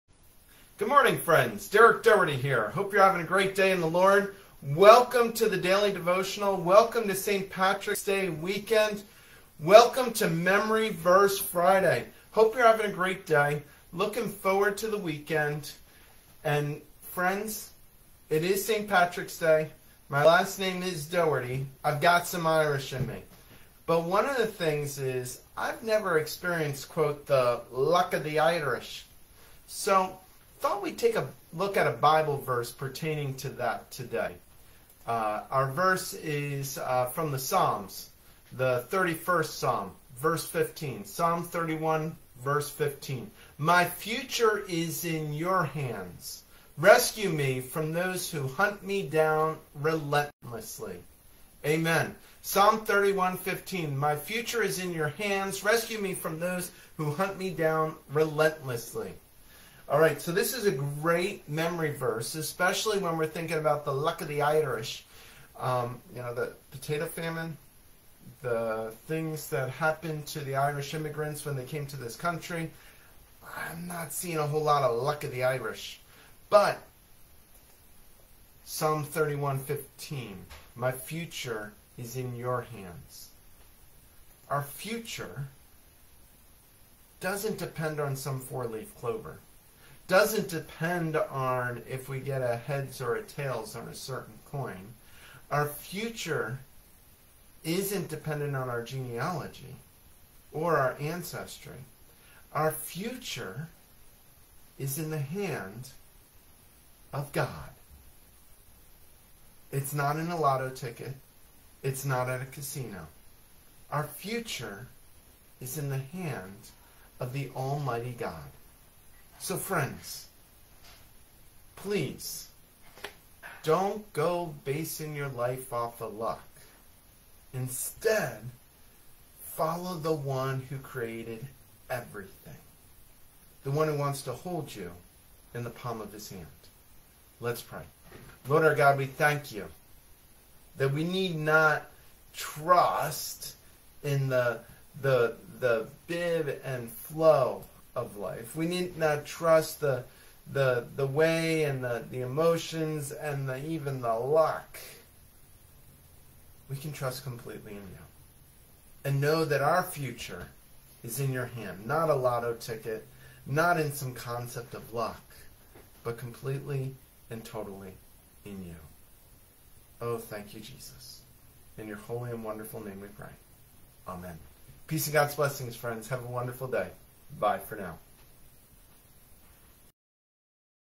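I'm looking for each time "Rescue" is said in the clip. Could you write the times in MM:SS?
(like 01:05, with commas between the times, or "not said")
00:46, 00:55.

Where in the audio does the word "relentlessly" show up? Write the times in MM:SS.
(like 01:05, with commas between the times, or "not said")
00:49, 00:58.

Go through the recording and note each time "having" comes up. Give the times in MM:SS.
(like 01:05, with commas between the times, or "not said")
00:03, 00:12.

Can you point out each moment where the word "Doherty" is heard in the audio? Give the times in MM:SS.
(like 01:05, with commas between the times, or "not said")
00:02, 00:21.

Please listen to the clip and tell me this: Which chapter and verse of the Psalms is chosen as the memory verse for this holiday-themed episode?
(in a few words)
Psalm 31:15.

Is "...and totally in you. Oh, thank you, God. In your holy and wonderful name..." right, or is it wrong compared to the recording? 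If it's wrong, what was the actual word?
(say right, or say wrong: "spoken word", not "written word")
wrong: "Jesus", not "God".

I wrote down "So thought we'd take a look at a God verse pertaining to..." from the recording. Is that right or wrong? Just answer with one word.
wrong.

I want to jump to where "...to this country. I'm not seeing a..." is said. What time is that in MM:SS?
01:11.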